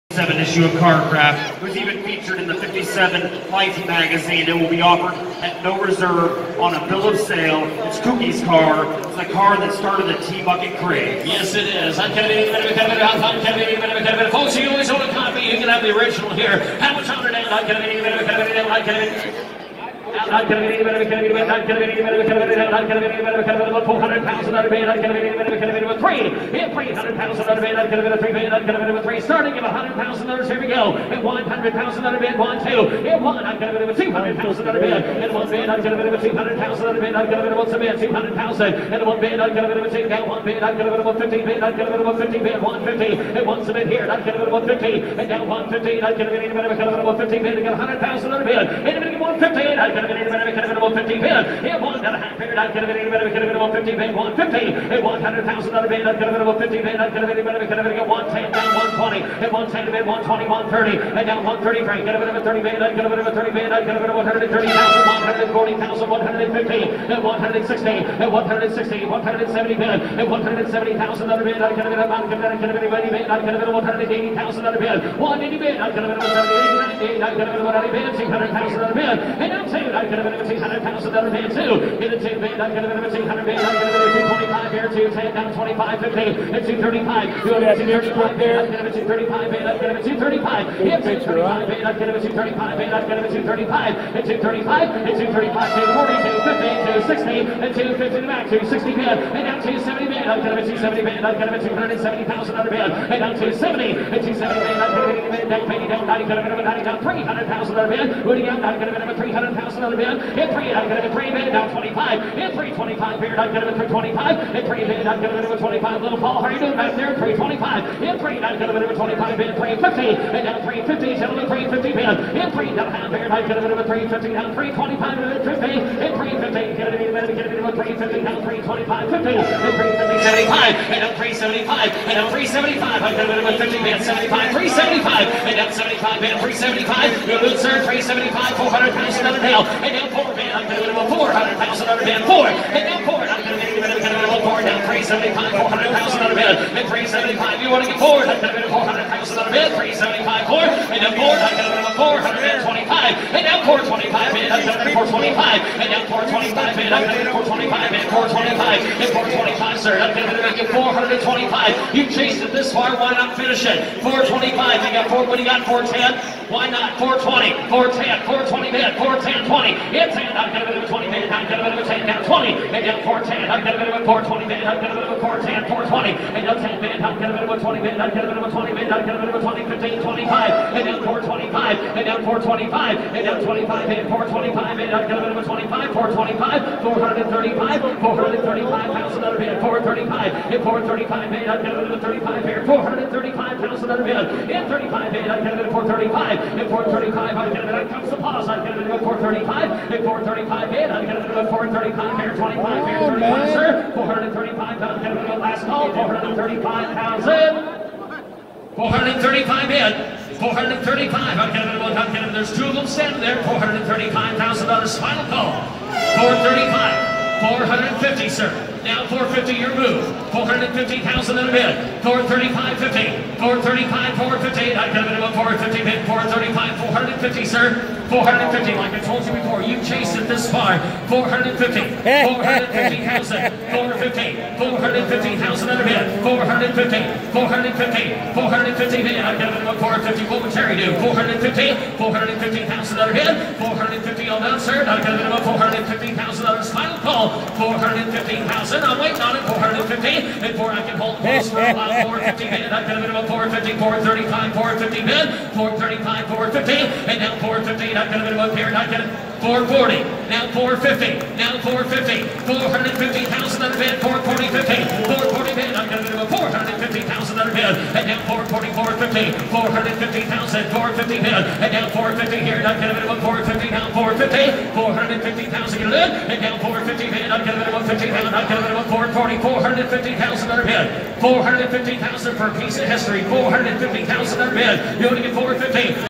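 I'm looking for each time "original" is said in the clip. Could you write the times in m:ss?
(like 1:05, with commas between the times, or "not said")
0:15.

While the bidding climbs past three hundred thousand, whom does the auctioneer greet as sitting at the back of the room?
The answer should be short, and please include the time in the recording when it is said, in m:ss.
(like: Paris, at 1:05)
Little Paul, at 1:56.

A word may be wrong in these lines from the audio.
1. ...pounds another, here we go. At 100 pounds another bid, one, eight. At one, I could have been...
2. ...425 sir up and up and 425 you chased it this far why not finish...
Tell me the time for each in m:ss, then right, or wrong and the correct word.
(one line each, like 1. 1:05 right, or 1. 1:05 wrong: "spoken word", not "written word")
1. 0:29 wrong: "two", not "eight"
2. 2:39 right.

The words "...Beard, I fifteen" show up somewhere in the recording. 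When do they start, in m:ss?
2:03.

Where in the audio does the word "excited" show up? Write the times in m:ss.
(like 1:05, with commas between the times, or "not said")
not said.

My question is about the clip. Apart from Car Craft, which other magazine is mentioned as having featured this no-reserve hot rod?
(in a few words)
57 Life.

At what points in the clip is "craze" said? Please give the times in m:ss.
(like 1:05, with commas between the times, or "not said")
0:10.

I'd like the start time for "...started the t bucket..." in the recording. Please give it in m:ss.
0:09.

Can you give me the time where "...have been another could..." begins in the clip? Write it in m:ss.
0:25.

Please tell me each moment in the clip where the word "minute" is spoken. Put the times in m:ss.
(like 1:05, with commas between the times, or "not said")
2:07, 4:12.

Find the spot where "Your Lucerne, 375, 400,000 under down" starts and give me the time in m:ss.
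2:17.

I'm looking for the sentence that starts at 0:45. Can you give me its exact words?
And now 115, I could a been with 15 bid, I got 100 pounds a bid.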